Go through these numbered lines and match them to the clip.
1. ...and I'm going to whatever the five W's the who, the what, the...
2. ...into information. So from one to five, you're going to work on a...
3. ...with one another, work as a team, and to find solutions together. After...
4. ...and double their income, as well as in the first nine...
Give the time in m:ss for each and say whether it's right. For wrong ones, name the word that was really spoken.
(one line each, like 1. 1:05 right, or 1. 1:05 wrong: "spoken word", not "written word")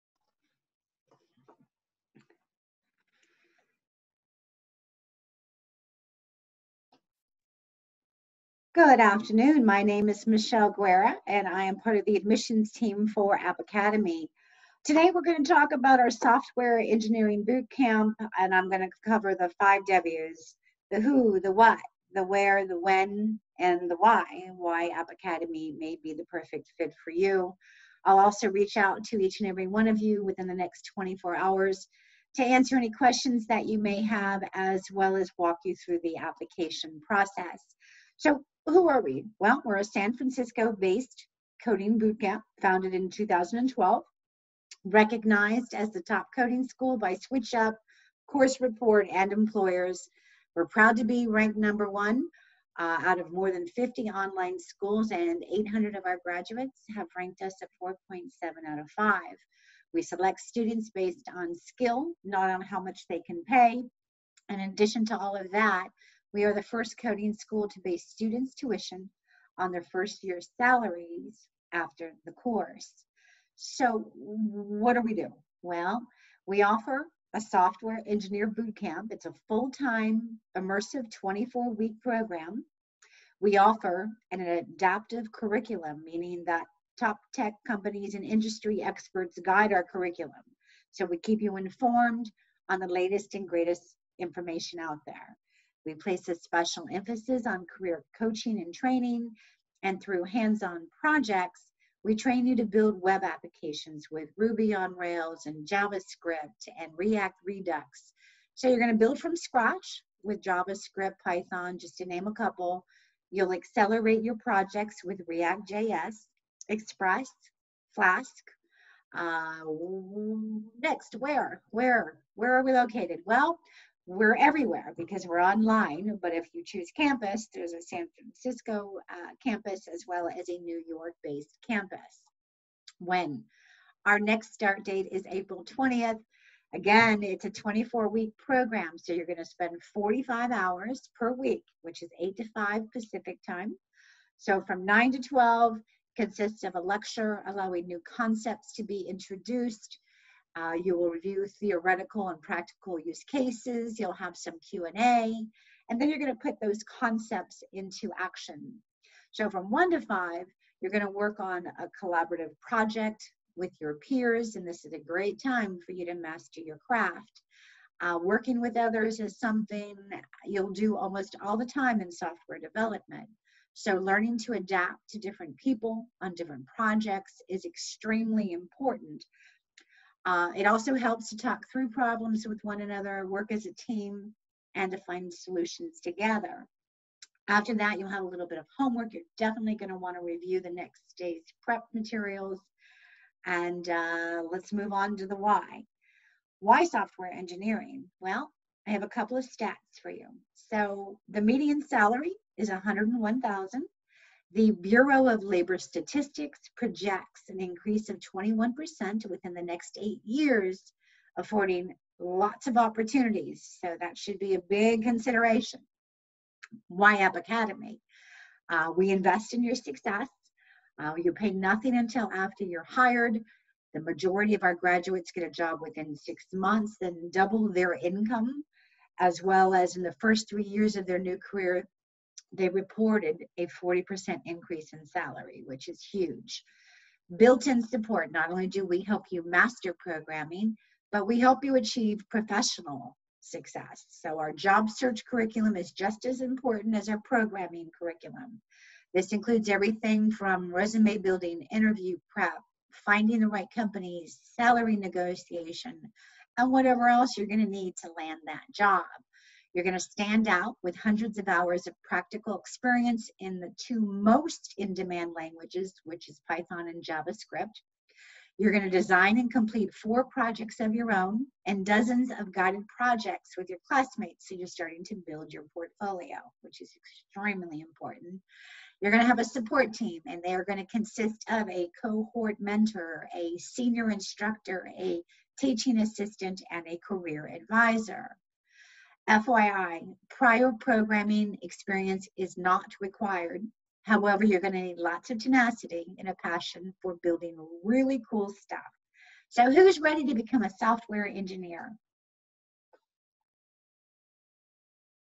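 1. 0:18 wrong: "cover", not "whatever"
2. 2:37 wrong: "action", not "information"
3. 3:02 right
4. 3:46 wrong: "three", not "nine".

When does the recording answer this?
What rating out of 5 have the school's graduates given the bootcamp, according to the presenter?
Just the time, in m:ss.
0:57.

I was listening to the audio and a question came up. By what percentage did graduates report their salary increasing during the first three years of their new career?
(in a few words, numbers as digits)
40%.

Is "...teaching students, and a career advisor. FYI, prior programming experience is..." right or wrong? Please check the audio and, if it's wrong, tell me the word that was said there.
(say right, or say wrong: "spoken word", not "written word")
wrong: "assistant", not "students".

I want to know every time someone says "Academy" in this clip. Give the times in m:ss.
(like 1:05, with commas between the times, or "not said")
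0:13, 0:25, 3:37.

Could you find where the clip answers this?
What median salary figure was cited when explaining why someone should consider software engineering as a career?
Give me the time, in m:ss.
3:22.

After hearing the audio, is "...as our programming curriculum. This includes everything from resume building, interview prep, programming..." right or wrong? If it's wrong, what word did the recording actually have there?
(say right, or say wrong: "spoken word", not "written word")
wrong: "finding", not "programming".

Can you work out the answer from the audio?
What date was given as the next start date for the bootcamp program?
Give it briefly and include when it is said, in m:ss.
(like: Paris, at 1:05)
April 20th, at 2:15.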